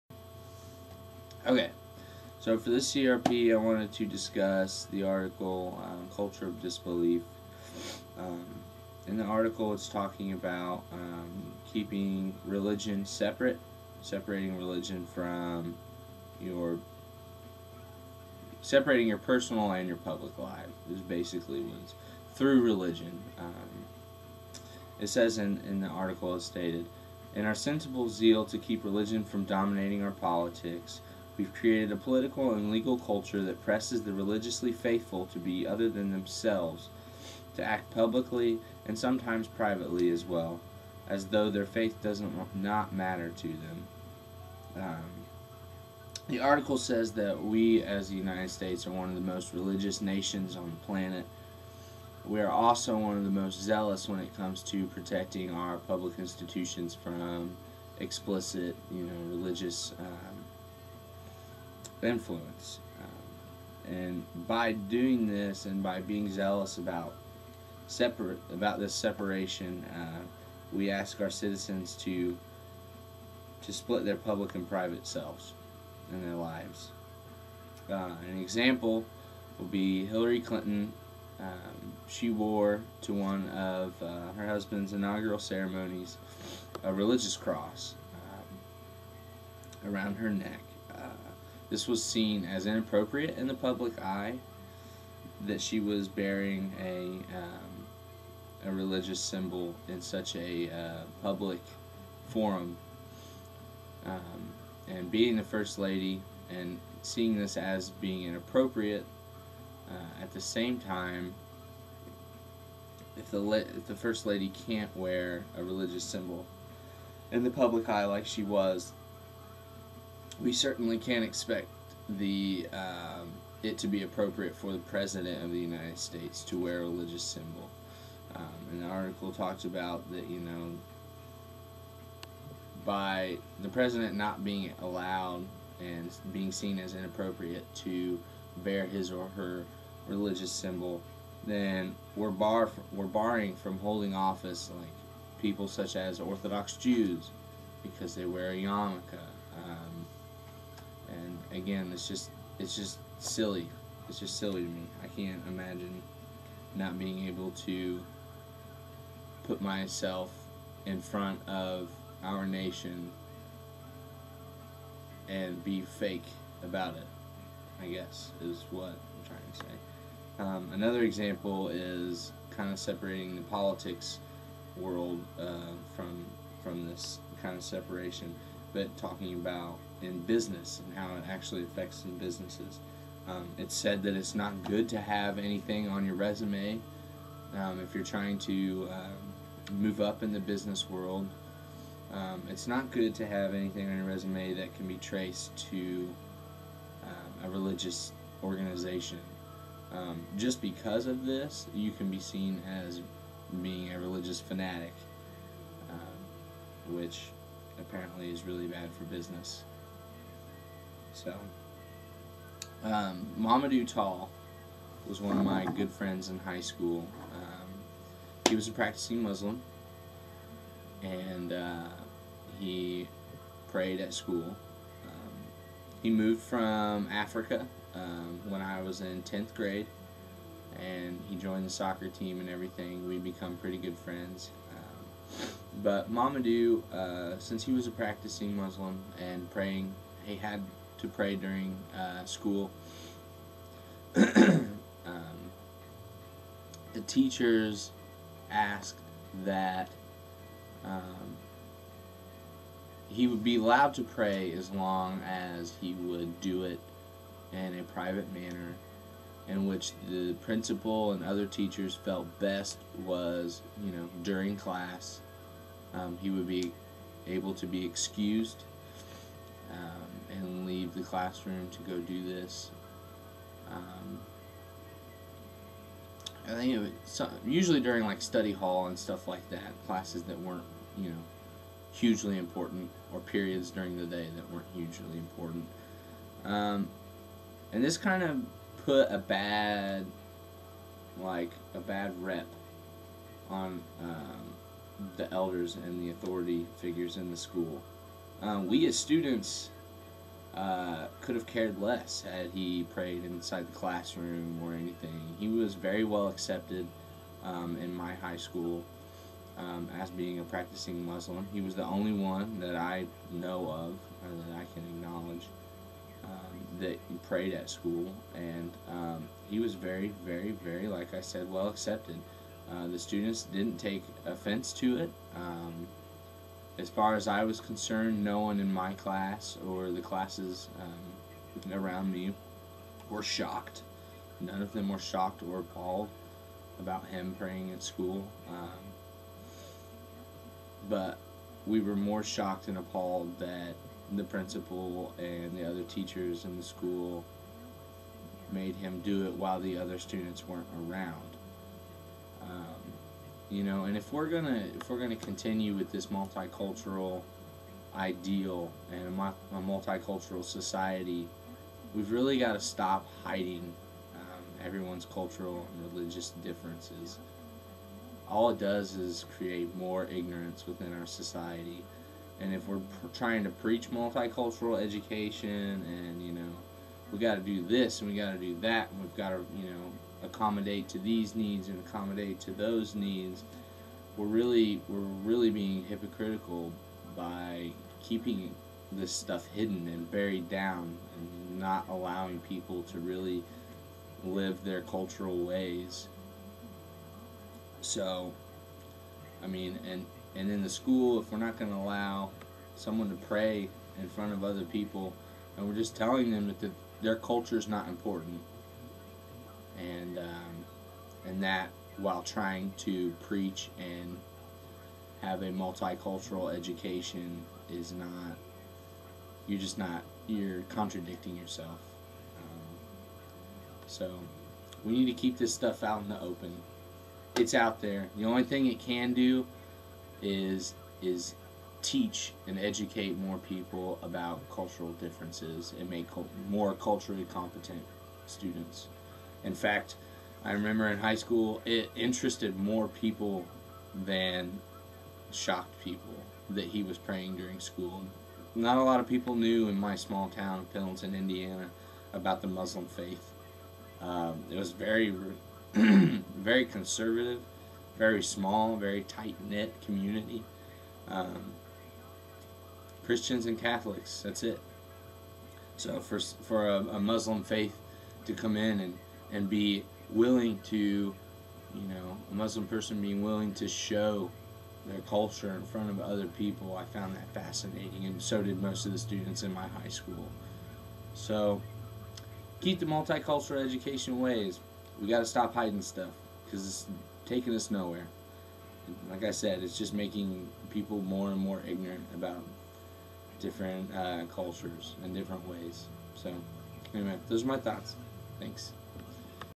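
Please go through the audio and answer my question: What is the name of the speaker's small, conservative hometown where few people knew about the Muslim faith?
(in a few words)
Pendleton, Indiana.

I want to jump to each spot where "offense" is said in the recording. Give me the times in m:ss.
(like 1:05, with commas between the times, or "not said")
5:24.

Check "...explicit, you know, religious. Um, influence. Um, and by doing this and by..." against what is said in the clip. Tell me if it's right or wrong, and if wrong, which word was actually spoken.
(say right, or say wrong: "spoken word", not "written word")
right.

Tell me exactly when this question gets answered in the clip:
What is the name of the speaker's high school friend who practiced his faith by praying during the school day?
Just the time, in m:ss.
3:33.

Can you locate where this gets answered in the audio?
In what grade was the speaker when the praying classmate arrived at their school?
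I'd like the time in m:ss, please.
3:49.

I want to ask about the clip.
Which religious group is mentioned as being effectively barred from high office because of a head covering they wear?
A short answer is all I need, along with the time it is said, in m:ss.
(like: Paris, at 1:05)
Orthodox Jews, at 2:26.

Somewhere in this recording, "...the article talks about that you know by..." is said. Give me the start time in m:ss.
2:08.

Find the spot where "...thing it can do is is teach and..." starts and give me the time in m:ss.
7:08.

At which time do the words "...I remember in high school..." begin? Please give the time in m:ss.
7:20.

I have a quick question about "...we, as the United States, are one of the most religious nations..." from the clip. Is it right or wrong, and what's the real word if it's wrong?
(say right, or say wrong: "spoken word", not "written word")
right.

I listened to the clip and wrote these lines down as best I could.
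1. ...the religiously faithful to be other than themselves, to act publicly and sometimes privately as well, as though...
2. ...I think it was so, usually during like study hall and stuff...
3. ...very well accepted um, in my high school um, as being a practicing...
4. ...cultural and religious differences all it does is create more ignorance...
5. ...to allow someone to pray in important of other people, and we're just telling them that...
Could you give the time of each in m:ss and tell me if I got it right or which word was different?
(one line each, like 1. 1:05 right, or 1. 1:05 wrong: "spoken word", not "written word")
1. 0:34 right
2. 4:36 right
3. 5:05 right
4. 6:05 right
5. 6:41 wrong: "front", not "important".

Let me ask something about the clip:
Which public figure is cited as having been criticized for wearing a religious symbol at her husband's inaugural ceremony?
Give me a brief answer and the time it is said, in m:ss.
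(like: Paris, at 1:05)
Hillary Clinton, at 1:20.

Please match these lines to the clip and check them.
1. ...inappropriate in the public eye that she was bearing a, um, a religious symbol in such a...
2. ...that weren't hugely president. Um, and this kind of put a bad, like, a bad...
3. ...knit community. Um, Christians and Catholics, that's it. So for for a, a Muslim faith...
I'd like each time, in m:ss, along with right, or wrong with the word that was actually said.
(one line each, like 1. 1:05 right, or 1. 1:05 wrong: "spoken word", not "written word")
1. 1:32 right
2. 4:44 wrong: "important", not "president"
3. 7:39 right.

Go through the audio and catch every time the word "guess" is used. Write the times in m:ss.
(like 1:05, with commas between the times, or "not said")
2:47.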